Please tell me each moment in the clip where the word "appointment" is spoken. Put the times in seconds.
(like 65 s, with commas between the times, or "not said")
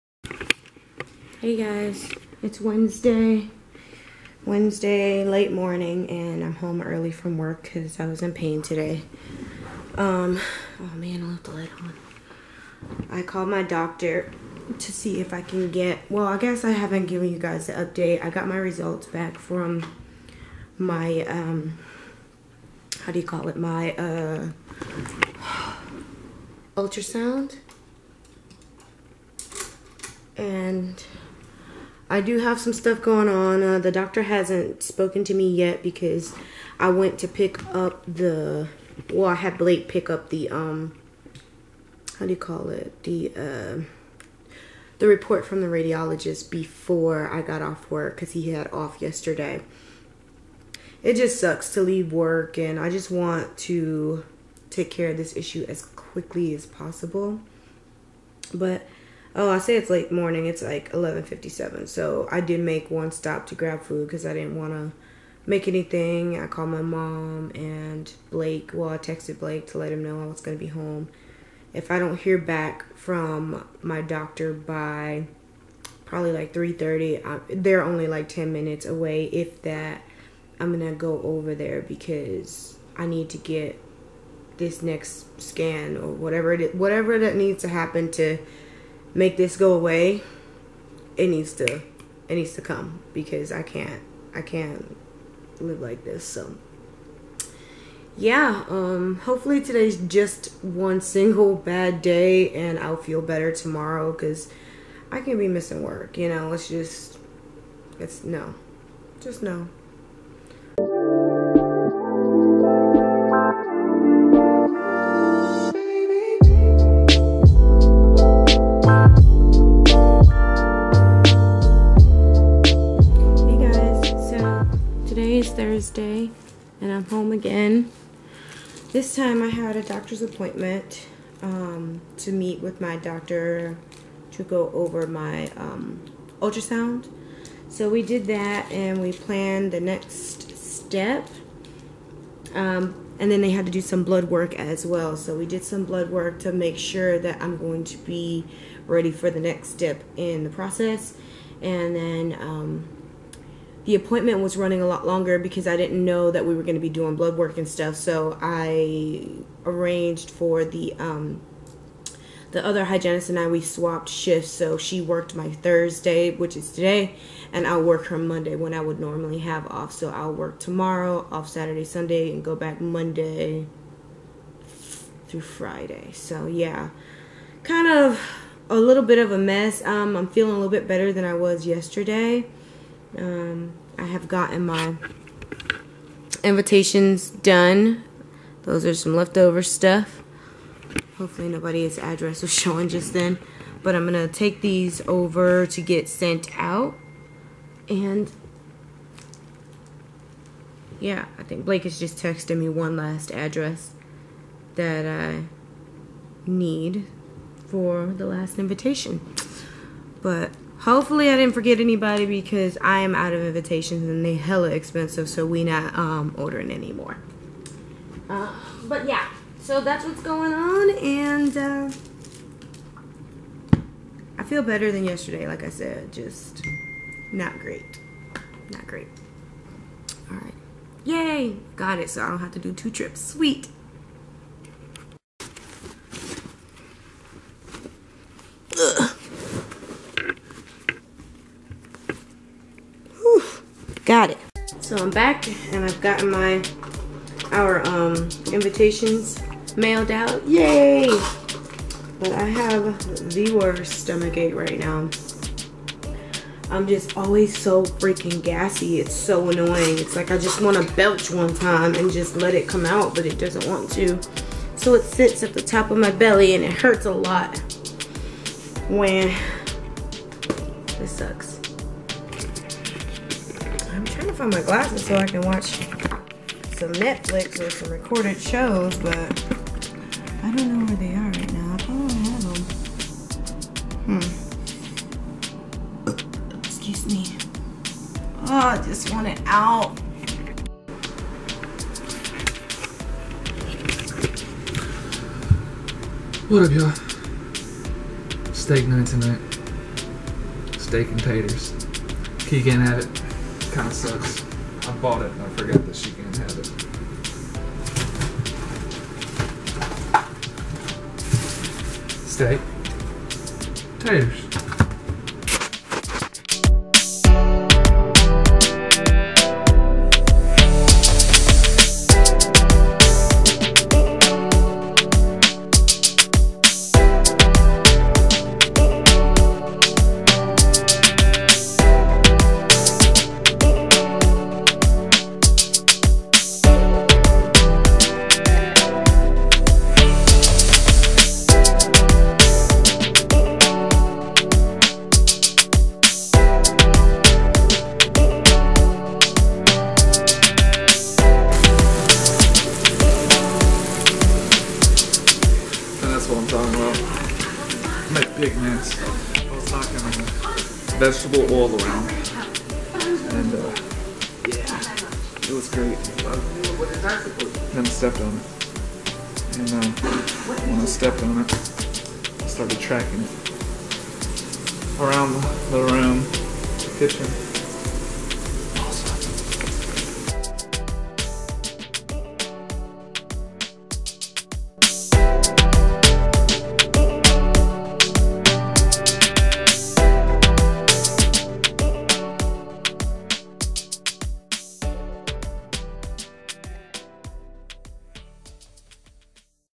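130 s, 153 s.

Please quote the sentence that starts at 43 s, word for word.
The, uh, the report from the radiologist before I got off work because he had off yesterday.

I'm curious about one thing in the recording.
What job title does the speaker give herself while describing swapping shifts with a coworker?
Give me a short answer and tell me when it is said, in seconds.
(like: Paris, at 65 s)
hygienist, at 162 s.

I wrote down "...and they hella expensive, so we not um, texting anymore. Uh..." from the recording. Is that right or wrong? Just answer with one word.
wrong.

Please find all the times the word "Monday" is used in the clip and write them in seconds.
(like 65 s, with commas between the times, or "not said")
168 s, 172 s.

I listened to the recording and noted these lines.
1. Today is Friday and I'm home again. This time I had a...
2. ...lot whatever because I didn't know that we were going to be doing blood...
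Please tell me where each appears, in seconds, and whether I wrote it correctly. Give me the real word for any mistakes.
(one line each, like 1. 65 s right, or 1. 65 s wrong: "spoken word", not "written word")
1. 125 s wrong: "Thursday", not "Friday"
2. 154 s wrong: "longer", not "whatever".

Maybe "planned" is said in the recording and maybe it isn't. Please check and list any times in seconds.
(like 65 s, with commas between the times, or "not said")
139 s.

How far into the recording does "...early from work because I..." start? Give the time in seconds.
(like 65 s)
6 s.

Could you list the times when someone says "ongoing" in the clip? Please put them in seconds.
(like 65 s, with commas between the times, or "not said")
not said.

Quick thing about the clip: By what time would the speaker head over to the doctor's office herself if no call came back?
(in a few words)
3:30.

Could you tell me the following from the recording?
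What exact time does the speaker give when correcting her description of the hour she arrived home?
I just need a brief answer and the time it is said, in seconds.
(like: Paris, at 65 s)
11:57, at 60 s.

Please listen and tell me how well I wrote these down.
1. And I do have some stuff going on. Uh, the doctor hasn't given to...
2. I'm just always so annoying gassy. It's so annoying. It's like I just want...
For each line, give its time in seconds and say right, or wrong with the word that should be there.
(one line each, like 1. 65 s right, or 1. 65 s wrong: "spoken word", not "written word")
1. 30 s wrong: "spoken", not "given"
2. 256 s wrong: "freaking", not "annoying".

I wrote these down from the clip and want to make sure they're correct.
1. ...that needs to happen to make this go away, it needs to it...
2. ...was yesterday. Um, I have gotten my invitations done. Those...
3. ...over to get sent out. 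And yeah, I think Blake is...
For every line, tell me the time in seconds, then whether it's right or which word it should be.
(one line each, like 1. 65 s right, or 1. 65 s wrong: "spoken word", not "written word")
1. 87 s right
2. 181 s right
3. 195 s right.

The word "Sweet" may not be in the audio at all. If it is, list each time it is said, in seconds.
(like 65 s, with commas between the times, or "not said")
233 s.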